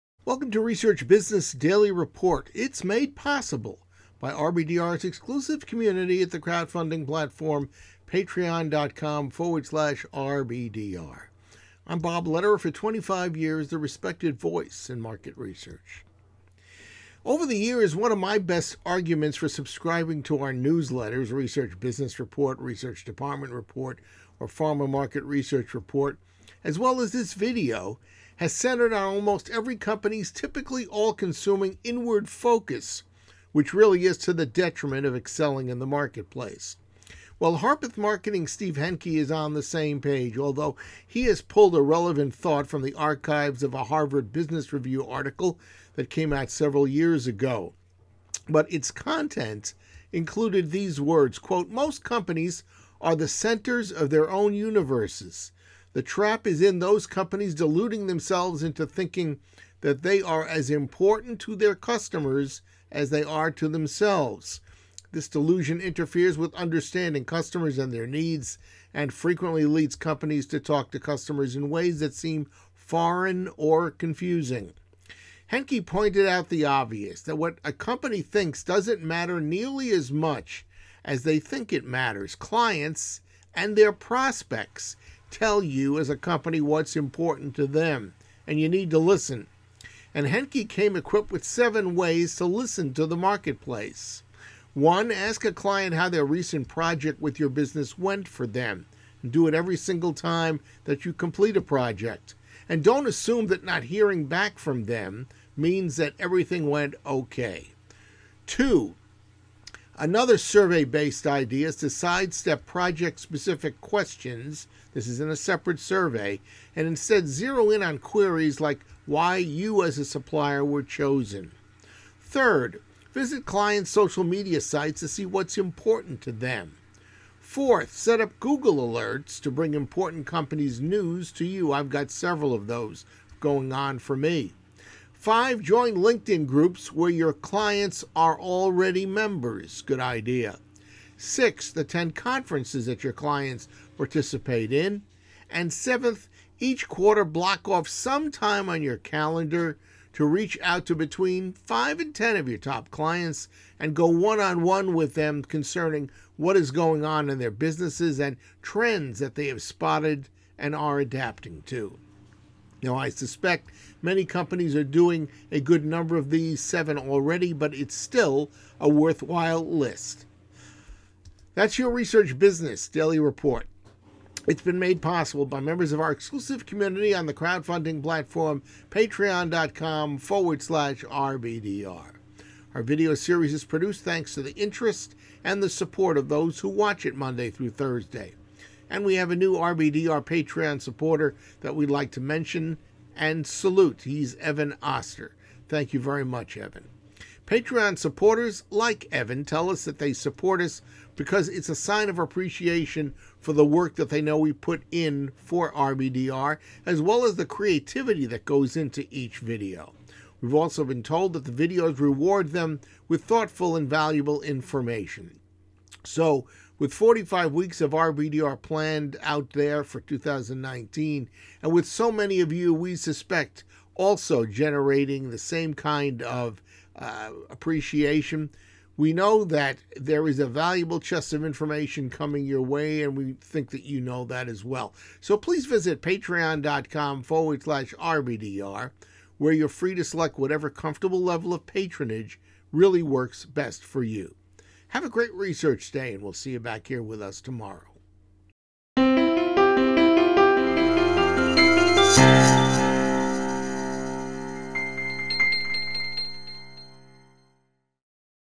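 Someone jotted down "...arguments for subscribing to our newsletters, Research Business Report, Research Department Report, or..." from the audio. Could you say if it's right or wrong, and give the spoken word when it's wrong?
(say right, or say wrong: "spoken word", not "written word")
right.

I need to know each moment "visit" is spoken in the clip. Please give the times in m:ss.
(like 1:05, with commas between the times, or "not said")
2:03, 3:55.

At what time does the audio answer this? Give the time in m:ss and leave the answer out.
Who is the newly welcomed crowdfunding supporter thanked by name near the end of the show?
3:14.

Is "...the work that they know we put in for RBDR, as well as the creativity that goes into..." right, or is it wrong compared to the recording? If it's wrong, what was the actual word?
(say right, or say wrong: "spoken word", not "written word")
right.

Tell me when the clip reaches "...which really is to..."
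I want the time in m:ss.
0:33.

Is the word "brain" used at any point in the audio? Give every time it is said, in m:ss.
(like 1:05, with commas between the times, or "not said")
not said.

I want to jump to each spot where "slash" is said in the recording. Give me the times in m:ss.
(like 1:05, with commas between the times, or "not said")
0:09, 3:00, 3:57.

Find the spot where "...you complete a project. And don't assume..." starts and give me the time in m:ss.
1:41.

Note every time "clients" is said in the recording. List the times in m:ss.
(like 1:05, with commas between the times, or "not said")
1:22, 1:35, 2:03, 2:17, 2:23, 2:32.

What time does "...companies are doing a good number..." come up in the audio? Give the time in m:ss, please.
2:44.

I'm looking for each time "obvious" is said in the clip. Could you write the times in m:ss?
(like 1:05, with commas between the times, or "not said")
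1:16.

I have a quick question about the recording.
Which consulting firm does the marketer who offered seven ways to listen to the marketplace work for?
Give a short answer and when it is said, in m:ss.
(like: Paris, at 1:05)
Harpeth Marketing, at 0:37.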